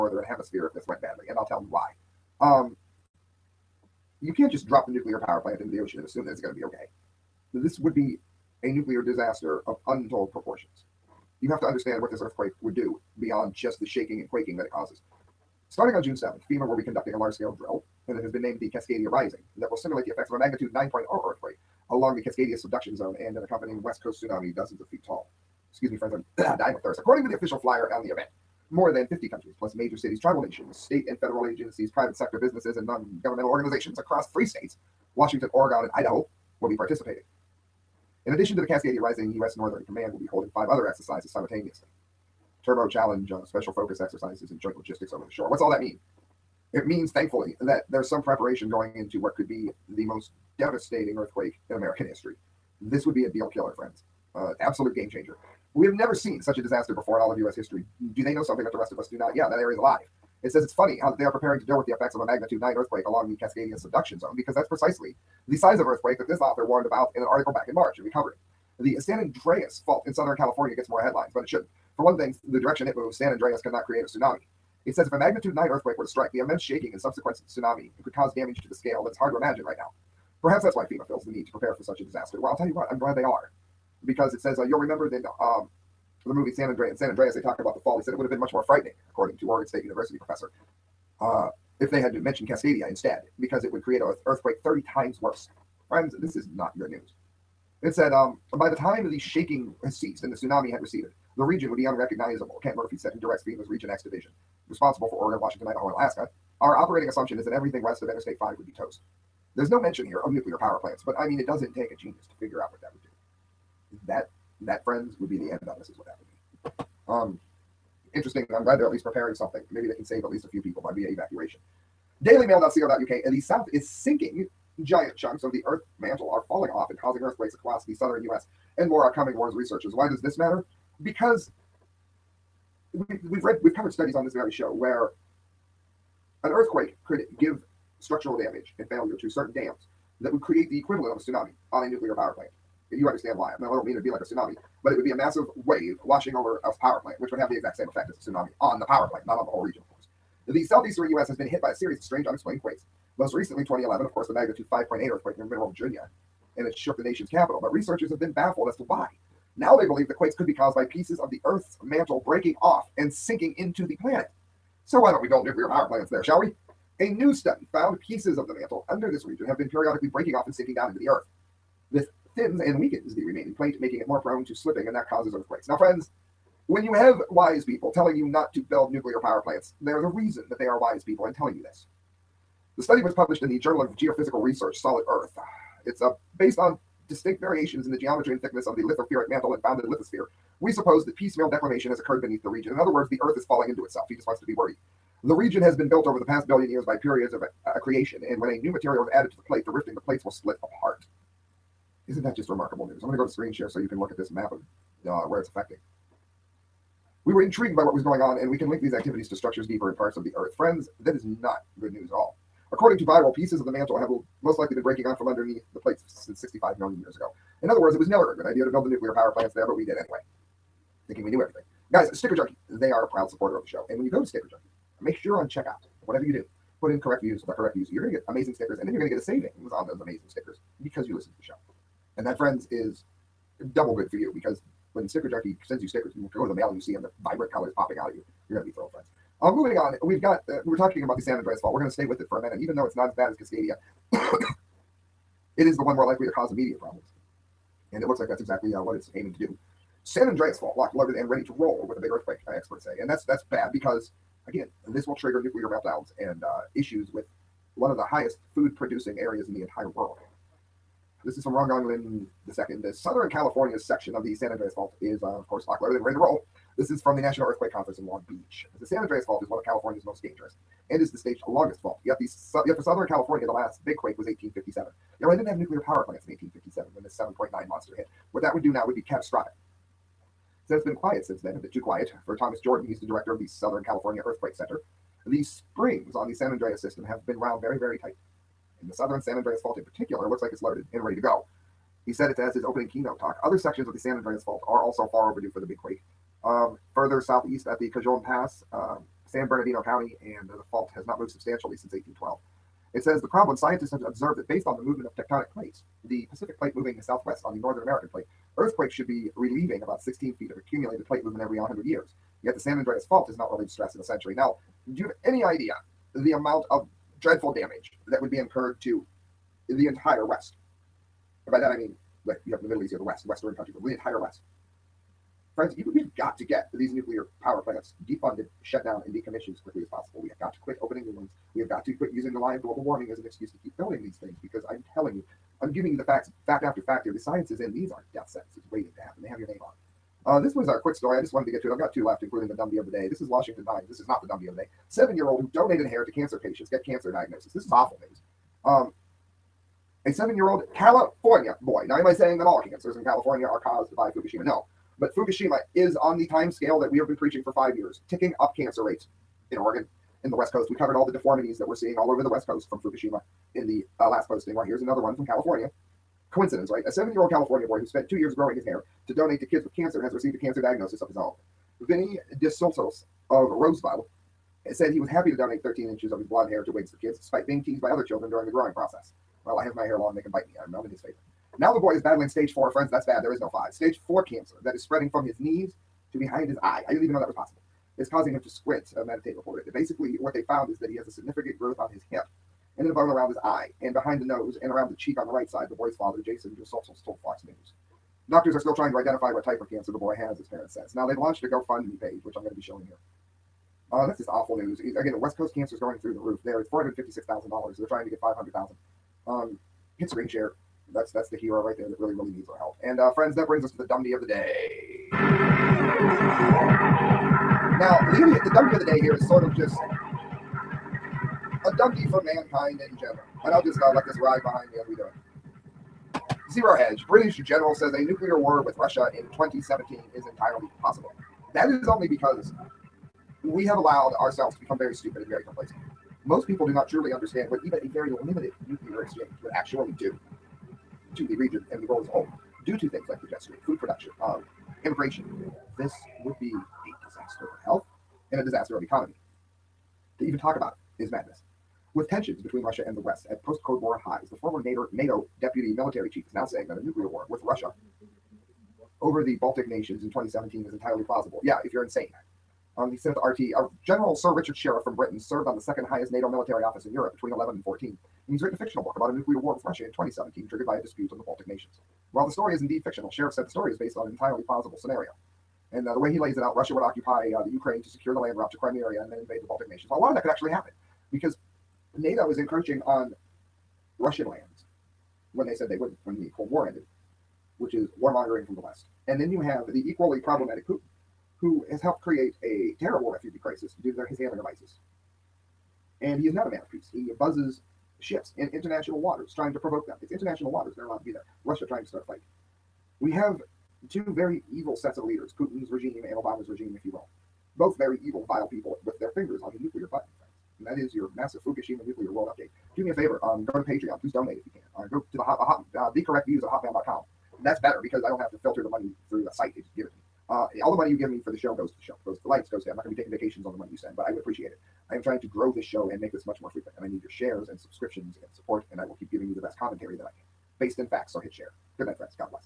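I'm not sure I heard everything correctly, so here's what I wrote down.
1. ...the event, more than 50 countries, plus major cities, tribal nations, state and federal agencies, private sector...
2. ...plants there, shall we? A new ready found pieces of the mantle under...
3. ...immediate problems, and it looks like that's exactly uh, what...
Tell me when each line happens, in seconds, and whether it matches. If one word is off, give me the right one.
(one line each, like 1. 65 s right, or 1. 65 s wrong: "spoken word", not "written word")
1. 28 s right
2. 165 s wrong: "study", not "ready"
3. 246 s right.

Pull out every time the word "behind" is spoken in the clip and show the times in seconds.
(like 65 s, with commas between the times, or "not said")
386 s, 393 s, 424 s.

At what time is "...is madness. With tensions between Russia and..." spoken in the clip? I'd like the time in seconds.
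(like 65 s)
451 s.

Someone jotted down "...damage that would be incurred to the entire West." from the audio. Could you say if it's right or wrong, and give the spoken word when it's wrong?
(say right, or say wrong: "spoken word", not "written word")
right.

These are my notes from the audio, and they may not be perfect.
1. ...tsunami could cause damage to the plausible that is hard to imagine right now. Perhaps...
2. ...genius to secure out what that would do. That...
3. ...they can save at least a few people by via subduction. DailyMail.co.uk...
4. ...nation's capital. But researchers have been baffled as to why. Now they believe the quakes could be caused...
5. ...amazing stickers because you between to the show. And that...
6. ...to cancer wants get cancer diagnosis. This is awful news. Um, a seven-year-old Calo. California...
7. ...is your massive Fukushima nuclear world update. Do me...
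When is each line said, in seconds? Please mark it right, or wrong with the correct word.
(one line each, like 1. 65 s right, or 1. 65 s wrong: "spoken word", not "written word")
1. 77 s wrong: "scale", not "plausible"
2. 111 s wrong: "figure", not "secure"
3. 119 s wrong: "evacuation", not "subduction"
4. 157 s right
5. 230 s wrong: "listen", not "between"
6. 346 s wrong: "patients", not "wants"
7. 510 s right.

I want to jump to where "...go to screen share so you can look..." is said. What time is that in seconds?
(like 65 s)
203 s.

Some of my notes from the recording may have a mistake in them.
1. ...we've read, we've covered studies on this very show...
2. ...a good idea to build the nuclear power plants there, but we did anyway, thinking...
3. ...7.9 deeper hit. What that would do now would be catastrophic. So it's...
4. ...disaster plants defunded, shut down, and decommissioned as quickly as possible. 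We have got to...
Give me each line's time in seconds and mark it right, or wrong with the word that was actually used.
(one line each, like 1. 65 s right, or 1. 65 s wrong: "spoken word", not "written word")
1. 133 s right
2. 218 s right
3. 277 s wrong: "monster", not "deeper"
4. 327 s wrong: "power", not "disaster".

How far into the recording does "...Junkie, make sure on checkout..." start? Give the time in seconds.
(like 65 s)
224 s.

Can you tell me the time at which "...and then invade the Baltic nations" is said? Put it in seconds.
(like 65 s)
479 s.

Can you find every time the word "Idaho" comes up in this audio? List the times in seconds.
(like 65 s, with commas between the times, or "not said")
35 s, 105 s.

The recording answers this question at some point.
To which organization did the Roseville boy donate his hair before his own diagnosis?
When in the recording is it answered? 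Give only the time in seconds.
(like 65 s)
376 s.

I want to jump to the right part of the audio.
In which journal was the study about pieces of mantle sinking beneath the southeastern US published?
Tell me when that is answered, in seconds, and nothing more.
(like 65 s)
183 s.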